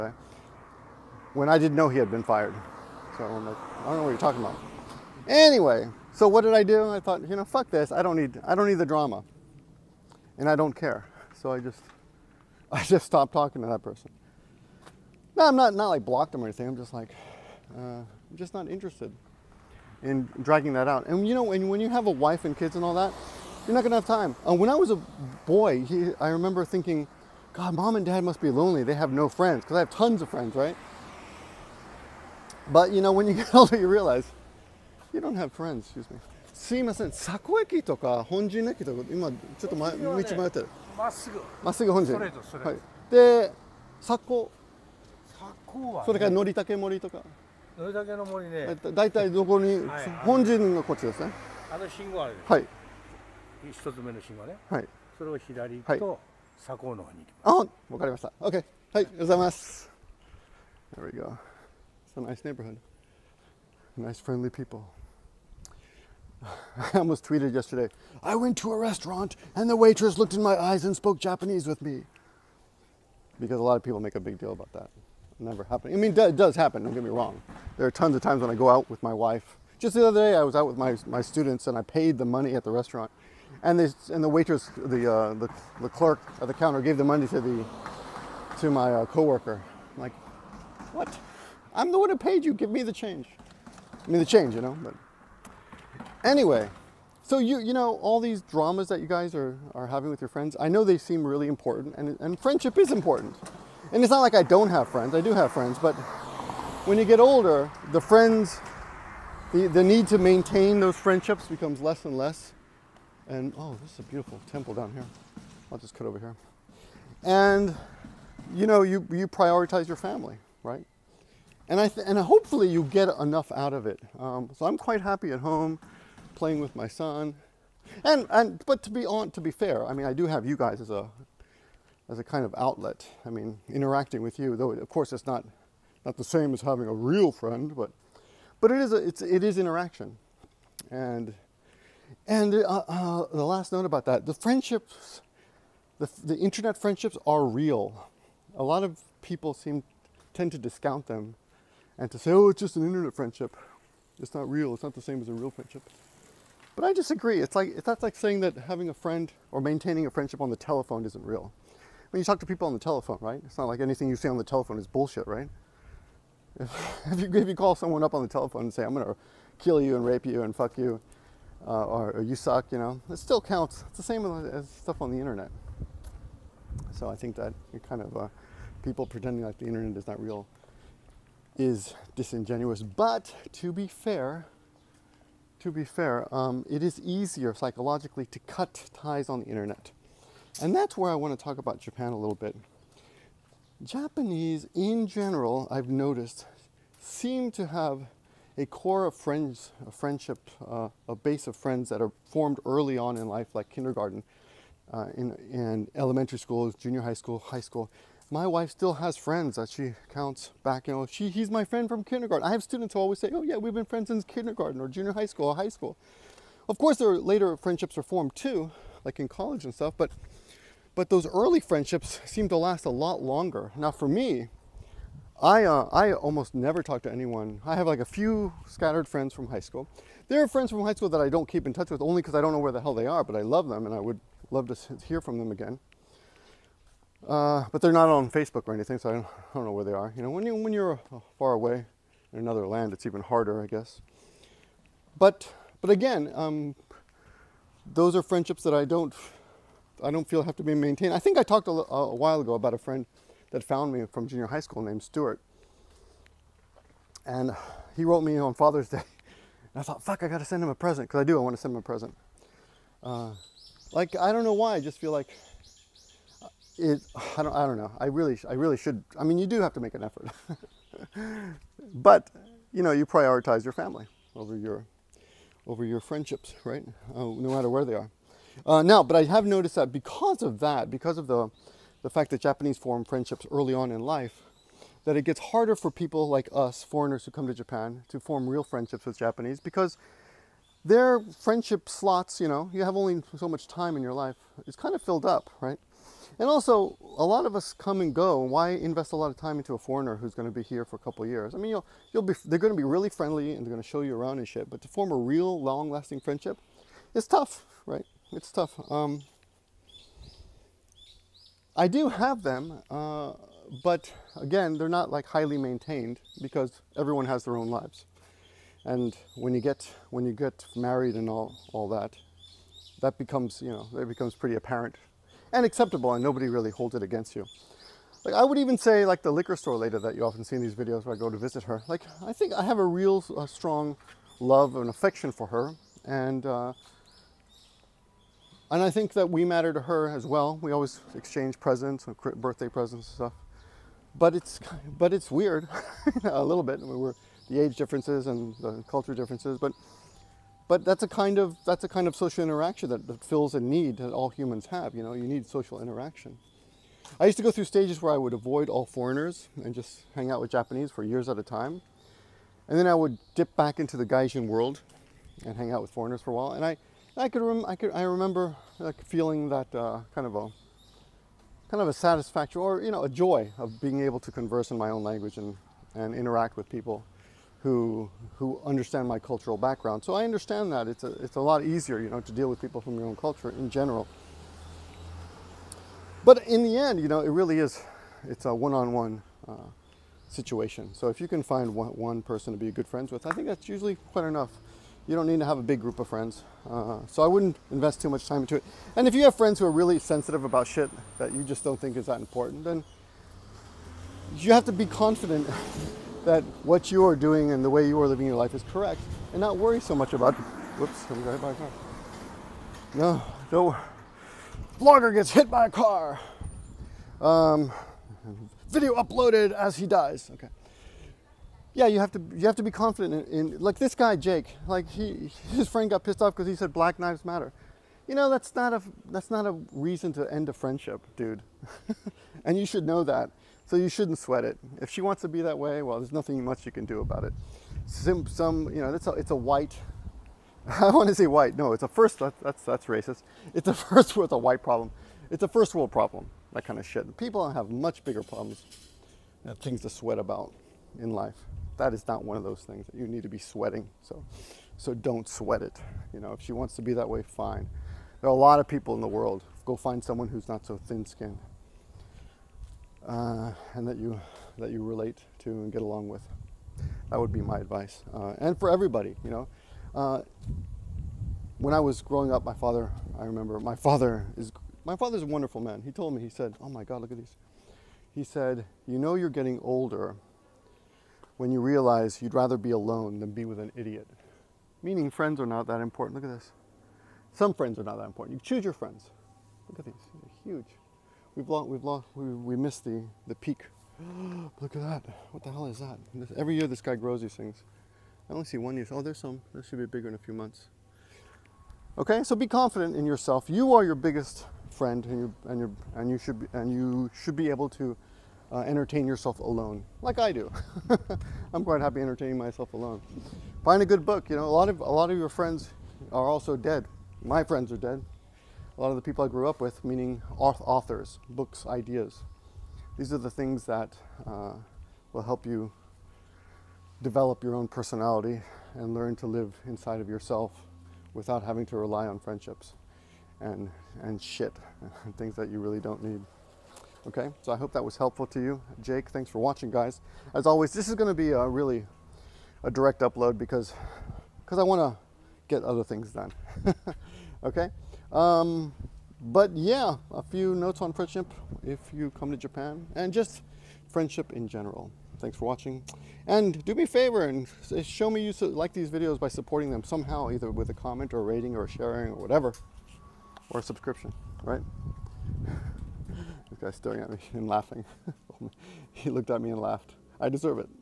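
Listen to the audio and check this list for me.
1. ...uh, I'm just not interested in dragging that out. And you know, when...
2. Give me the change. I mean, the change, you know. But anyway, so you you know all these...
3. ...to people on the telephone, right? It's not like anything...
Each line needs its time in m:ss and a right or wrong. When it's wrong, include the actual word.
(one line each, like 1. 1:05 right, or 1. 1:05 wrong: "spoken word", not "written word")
1. 0:17 right
2. 1:32 right
3. 2:42 right.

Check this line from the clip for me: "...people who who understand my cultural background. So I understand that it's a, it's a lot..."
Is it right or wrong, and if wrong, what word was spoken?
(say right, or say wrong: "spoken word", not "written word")
right.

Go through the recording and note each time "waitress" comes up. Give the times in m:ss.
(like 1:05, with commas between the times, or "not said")
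1:09, 1:24.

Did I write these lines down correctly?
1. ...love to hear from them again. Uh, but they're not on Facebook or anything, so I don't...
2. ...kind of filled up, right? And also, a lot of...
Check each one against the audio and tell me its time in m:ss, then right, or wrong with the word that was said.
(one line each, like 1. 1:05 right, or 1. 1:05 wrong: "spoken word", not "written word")
1. 3:54 right
2. 4:54 right.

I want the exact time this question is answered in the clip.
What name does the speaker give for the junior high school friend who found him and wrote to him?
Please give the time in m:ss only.
4:15.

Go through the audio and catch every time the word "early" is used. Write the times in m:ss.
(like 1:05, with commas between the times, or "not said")
3:22, 3:41, 4:43.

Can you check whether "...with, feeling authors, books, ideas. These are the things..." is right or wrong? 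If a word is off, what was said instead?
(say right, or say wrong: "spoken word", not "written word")
wrong: "meaning", not "feeling".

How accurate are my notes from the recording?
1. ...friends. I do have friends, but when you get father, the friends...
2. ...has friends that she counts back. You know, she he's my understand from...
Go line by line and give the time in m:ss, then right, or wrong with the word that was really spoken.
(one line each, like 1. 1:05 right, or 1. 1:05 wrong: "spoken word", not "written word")
1. 1:44 wrong: "older", not "father"
2. 3:28 wrong: "friend", not "understand".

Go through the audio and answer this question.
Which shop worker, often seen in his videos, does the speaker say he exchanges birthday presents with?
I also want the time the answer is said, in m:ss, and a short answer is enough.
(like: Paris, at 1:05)
the liquor store lady, at 5:29.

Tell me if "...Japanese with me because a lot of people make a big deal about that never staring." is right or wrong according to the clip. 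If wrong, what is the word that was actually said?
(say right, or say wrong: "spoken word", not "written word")
wrong: "happening", not "staring".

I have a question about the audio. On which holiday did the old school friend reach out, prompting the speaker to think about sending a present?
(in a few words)
Father's Day.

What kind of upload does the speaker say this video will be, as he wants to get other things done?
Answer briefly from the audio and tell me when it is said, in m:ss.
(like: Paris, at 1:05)
a direct upload, at 9:02.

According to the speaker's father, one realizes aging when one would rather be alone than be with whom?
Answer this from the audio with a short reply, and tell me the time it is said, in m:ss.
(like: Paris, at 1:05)
an idiot, at 8:03.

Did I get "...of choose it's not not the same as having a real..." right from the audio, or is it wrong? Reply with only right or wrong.
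wrong.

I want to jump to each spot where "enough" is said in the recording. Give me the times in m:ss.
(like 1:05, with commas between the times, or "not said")
2:03, 6:34.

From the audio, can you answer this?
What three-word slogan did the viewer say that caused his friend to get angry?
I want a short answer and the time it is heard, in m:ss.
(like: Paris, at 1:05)
Black Lives Matter, at 7:06.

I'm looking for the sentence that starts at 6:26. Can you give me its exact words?
But in the end, you know, it really is it's a one-on-one uh, situation.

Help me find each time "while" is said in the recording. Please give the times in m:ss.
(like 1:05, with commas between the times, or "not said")
4:12, 6:06.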